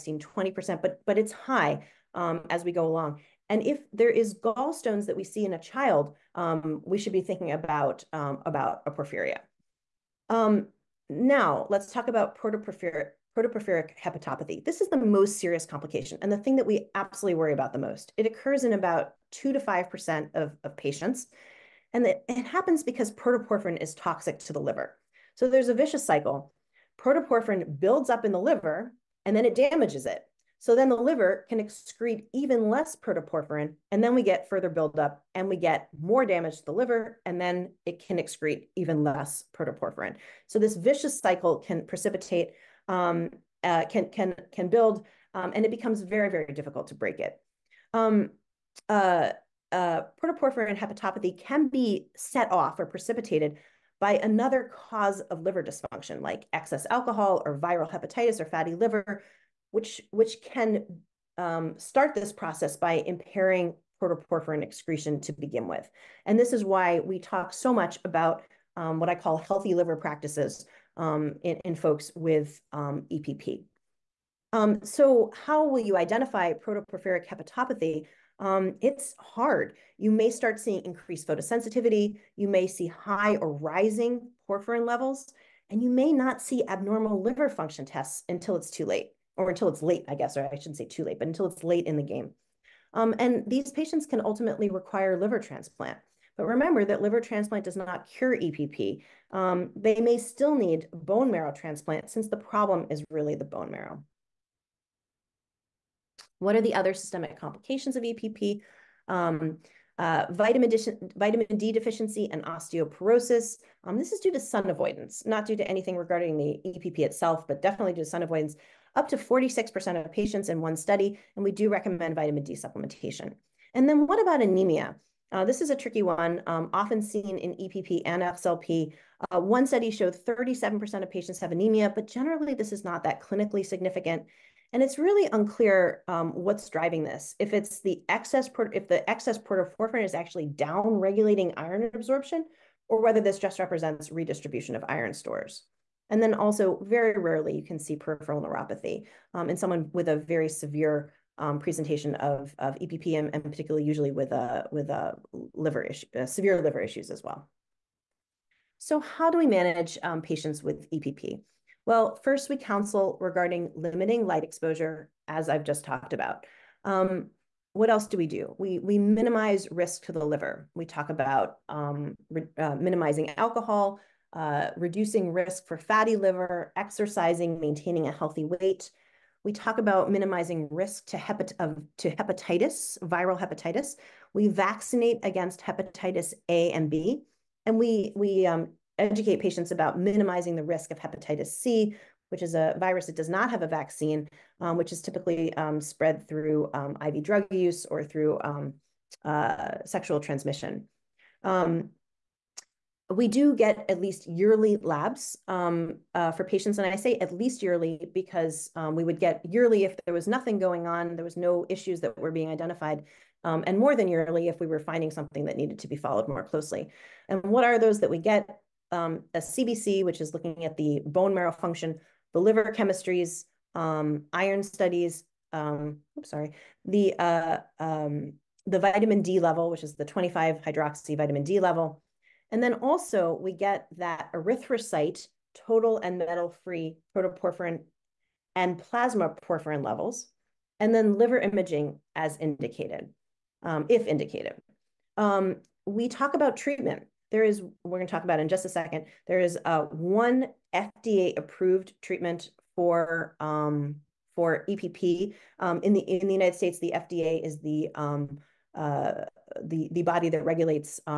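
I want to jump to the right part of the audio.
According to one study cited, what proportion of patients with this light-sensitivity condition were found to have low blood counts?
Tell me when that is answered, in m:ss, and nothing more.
2:10.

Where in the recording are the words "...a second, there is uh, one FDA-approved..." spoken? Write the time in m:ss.
4:08.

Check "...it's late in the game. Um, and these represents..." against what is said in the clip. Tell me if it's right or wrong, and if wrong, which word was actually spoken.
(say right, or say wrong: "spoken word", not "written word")
wrong: "patients", not "represents".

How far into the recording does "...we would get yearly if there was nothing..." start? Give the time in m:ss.
3:28.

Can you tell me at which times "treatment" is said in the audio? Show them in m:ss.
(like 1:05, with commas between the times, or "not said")
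4:06, 4:12.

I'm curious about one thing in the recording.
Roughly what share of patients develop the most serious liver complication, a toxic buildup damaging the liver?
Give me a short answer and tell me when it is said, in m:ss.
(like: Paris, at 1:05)
2 to 5%, at 0:19.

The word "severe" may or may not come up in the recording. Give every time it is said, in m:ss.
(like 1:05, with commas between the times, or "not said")
2:30, 2:36.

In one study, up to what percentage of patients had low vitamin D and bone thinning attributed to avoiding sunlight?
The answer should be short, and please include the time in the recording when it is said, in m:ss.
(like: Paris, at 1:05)
46%, at 1:59.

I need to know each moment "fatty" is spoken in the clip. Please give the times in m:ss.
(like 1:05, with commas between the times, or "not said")
0:58, 2:55.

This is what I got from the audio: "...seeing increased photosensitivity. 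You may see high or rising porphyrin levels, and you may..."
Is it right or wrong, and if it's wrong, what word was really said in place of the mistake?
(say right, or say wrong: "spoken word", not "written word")
right.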